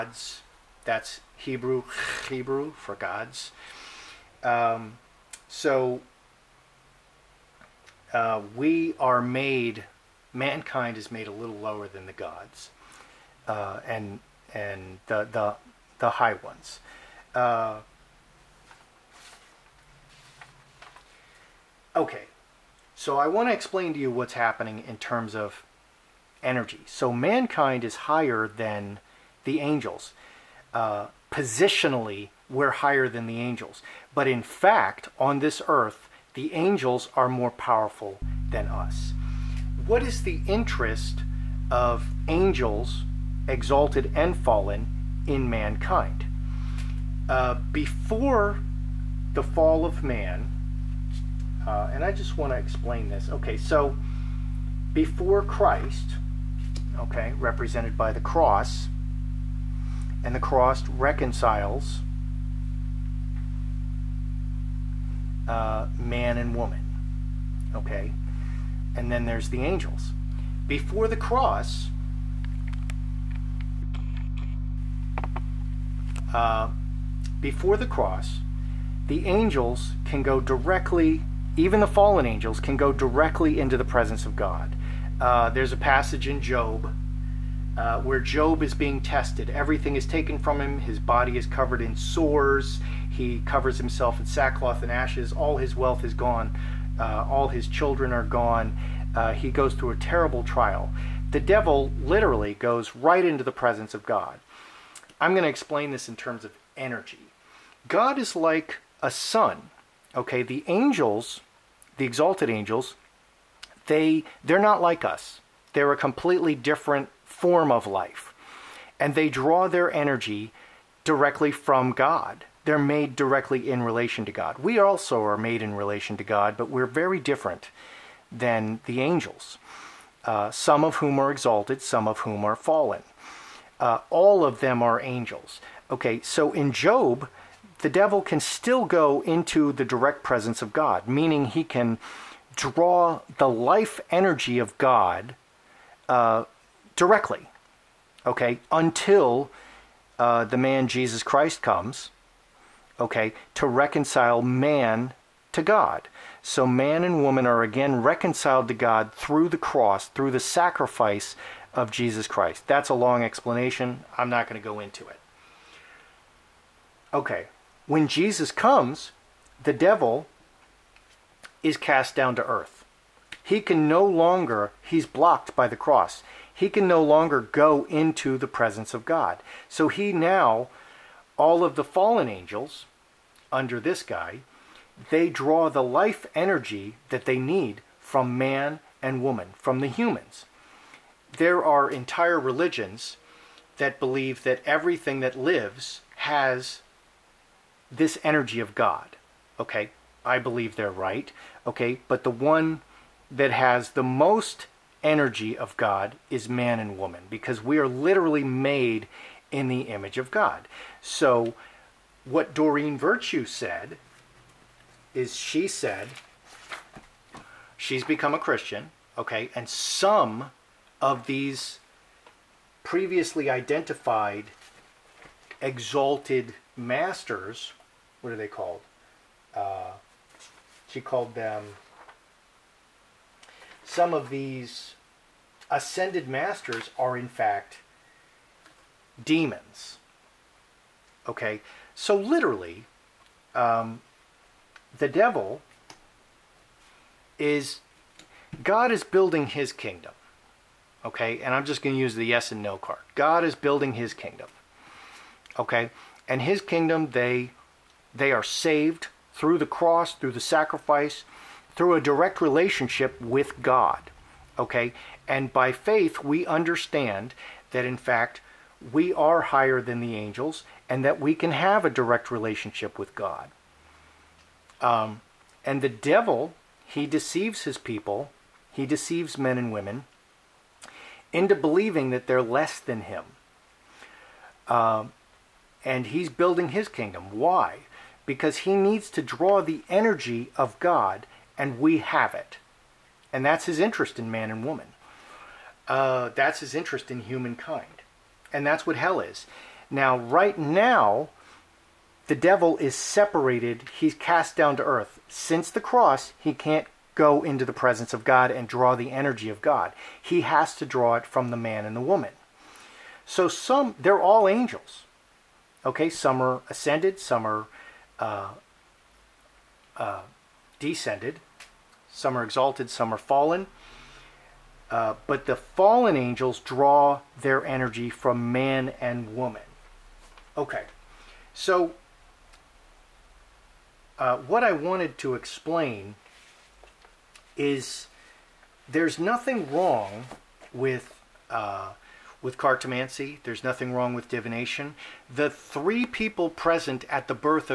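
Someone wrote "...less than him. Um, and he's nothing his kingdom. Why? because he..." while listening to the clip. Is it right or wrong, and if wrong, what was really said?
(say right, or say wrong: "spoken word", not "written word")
wrong: "building", not "nothing".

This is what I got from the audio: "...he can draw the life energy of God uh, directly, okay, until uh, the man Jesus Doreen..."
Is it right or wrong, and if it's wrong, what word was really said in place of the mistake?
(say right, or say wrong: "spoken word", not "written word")
wrong: "Christ", not "Doreen".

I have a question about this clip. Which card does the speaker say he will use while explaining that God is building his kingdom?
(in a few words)
The yes and no card.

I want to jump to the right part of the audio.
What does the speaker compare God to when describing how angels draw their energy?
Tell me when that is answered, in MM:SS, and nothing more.
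01:49.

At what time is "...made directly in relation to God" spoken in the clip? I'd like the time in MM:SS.
02:02.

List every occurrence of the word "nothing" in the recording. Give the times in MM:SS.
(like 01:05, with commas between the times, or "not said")
05:39, 05:43.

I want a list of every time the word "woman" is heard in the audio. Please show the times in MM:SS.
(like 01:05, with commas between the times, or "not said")
01:06, 02:37, 03:09, 03:26, 04:54, 05:12, 05:29.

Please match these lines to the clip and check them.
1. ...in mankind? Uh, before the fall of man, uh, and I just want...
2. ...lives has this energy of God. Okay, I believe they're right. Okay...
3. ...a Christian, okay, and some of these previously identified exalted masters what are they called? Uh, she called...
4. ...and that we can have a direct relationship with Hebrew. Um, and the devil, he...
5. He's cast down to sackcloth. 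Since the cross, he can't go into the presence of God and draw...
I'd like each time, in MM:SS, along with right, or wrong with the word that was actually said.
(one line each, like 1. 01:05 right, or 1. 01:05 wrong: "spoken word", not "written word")
1. 00:45 right
2. 03:15 right
3. 03:38 right
4. 04:30 wrong: "God", not "Hebrew"
5. 05:03 wrong: "earth", not "sackcloth".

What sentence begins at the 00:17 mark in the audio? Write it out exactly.
Uh, Okay, so I want to explain to you what's happening in terms of energy.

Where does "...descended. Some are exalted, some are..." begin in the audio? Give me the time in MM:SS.
05:20.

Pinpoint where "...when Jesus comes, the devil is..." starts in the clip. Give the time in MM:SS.
02:47.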